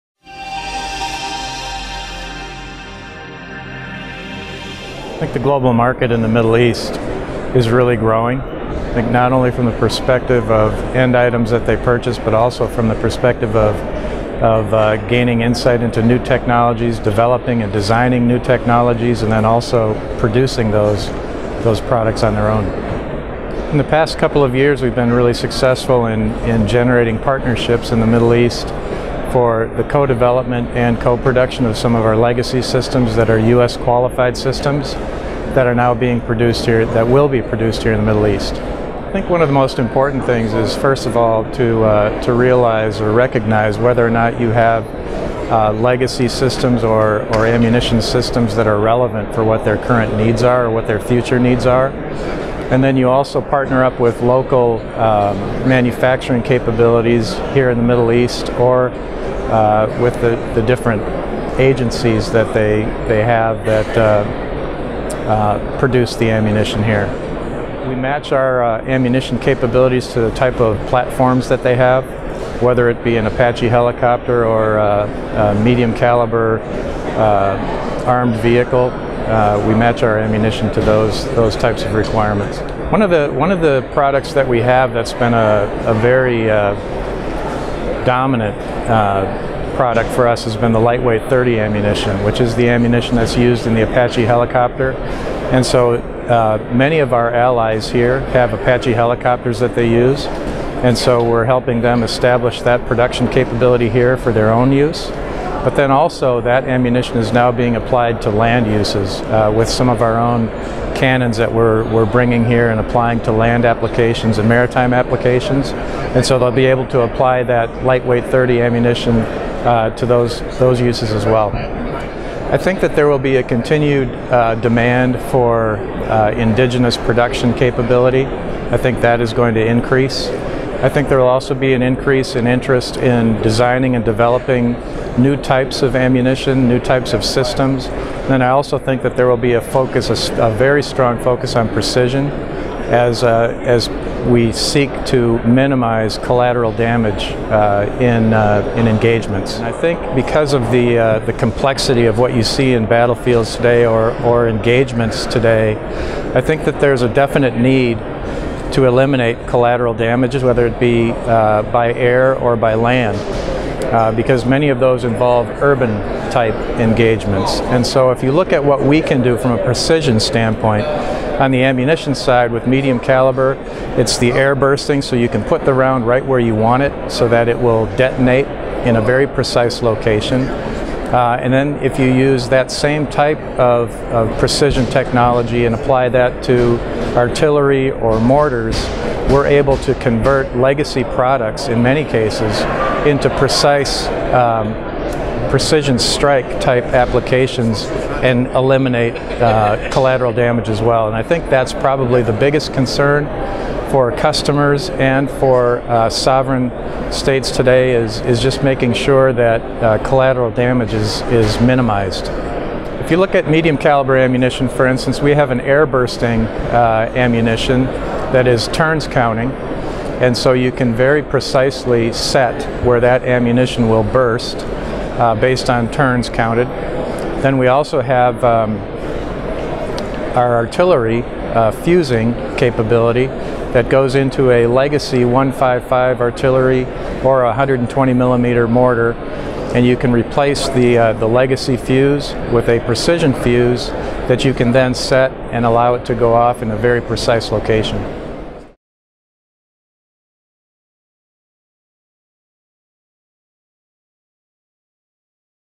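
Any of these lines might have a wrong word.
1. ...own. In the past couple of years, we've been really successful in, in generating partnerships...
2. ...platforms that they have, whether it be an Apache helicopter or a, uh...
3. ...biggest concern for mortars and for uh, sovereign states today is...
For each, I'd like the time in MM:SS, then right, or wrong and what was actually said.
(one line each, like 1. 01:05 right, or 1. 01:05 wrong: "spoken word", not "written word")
1. 00:22 right
2. 01:10 right
3. 03:22 wrong: "customers", not "mortars".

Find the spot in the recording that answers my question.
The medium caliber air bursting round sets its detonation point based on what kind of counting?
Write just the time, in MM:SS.
03:38.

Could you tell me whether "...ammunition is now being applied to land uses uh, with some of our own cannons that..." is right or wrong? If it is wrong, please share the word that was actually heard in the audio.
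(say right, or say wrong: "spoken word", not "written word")
right.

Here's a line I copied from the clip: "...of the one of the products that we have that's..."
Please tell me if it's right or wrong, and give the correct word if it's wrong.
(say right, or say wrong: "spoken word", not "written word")
right.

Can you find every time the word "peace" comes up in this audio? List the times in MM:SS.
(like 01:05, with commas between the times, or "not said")
not said.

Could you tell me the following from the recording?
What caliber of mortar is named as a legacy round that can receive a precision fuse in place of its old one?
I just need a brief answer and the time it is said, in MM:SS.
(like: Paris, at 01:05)
120 millimeter, at 03:57.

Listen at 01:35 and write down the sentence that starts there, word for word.
And so uh, many of our allies here have Apache helicopters that they use.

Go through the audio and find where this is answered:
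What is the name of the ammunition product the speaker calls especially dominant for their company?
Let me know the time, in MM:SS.
01:30.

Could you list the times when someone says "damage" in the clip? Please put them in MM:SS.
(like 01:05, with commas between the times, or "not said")
02:26, 02:39, 03:20, 03:30.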